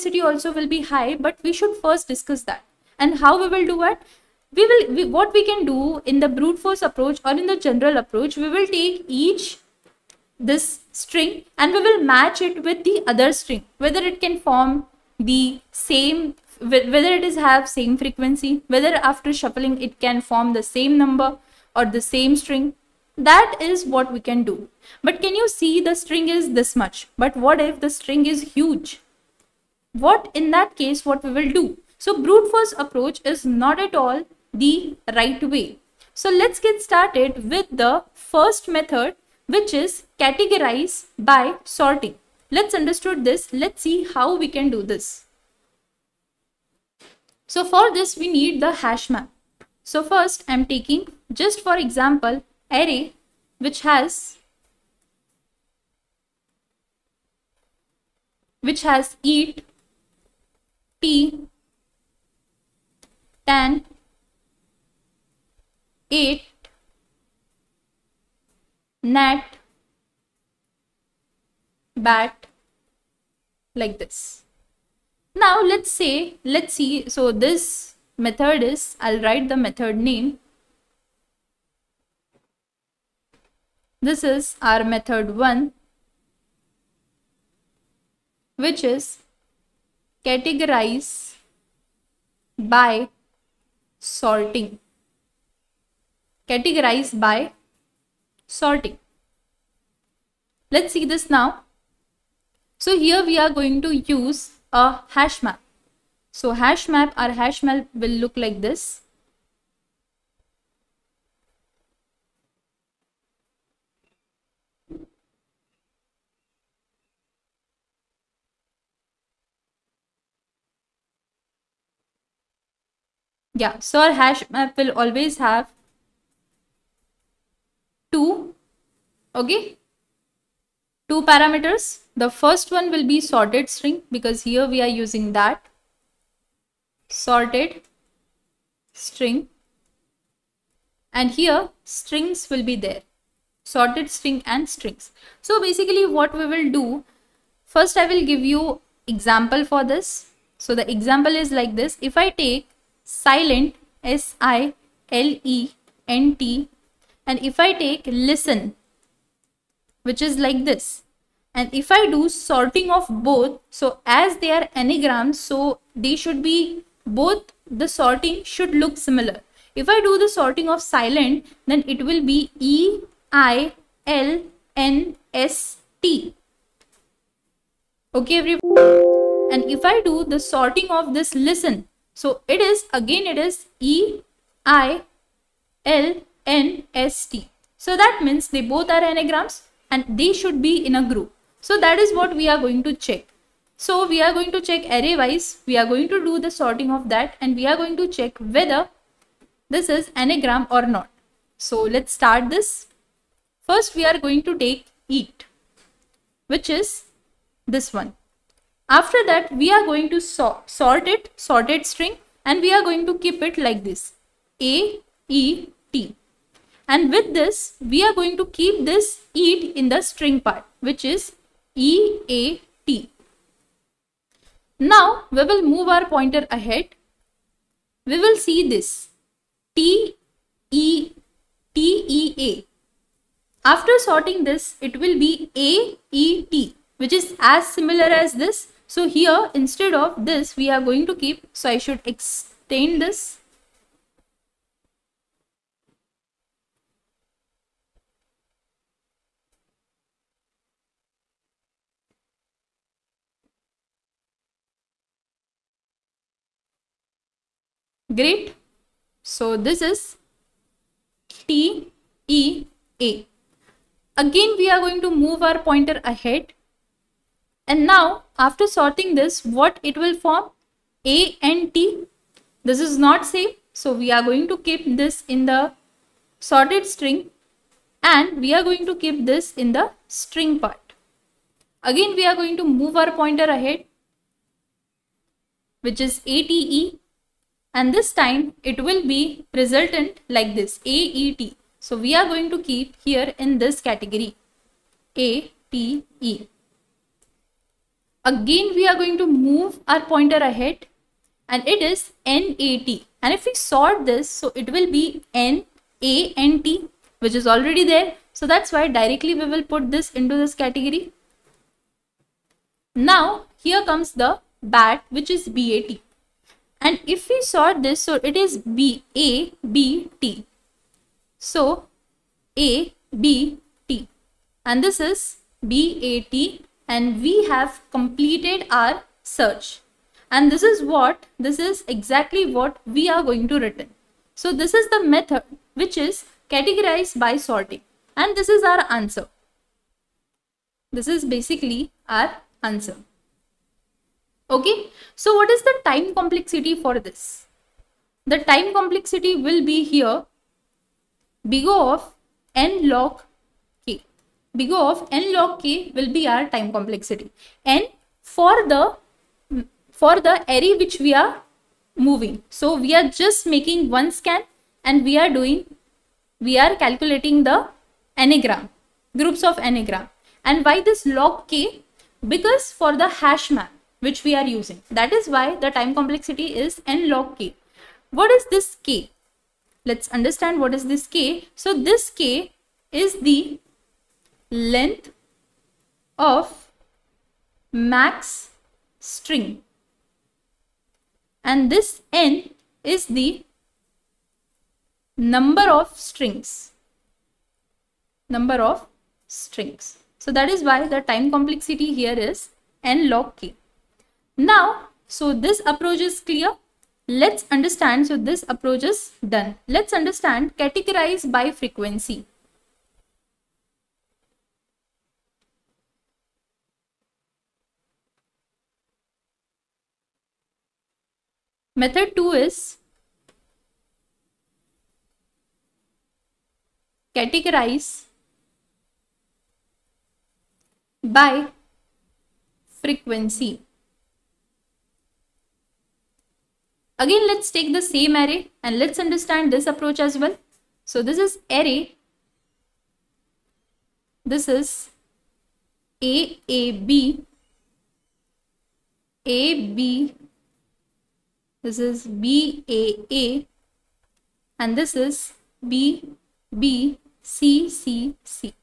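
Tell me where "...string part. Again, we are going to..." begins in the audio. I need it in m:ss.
4:40.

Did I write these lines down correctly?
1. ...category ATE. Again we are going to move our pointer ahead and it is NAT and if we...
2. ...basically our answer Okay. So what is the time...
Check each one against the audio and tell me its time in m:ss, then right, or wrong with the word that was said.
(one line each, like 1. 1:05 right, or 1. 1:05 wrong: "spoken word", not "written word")
1. 4:53 right
2. 5:41 right.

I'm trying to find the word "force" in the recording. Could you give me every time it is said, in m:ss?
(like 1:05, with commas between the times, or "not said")
0:06, 0:32.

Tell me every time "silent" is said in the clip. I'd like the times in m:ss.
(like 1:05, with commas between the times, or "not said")
2:33, 2:50.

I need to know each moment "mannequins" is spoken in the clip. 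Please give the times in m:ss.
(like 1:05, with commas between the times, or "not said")
not said.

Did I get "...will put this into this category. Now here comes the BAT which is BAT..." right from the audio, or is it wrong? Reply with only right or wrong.
right.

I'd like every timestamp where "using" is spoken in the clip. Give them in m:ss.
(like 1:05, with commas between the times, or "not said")
2:15, 6:14.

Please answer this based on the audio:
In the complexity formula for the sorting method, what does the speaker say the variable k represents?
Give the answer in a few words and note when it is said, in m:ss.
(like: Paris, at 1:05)
Length of max string, at 6:23.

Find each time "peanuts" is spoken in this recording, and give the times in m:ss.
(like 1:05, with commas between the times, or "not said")
not said.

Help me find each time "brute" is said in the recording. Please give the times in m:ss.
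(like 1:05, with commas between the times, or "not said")
0:06, 0:32.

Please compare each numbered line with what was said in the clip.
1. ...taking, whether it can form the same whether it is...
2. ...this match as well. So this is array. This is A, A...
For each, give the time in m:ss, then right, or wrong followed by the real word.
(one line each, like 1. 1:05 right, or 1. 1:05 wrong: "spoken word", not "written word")
1. 0:13 wrong: "string", not "taking"
2. 7:19 wrong: "approach", not "match".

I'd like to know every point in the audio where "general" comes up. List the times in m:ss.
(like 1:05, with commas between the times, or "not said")
0:07.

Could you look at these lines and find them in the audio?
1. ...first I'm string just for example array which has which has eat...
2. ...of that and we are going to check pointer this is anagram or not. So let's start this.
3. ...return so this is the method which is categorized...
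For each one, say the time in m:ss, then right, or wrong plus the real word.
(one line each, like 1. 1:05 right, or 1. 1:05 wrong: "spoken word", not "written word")
1. 0:50 wrong: "taking", not "string"
2. 3:16 wrong: "whether", not "pointer"
3. 5:33 right.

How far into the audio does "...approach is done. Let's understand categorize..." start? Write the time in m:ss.
6:48.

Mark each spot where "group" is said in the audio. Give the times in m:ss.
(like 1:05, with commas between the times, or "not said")
3:11, 6:09.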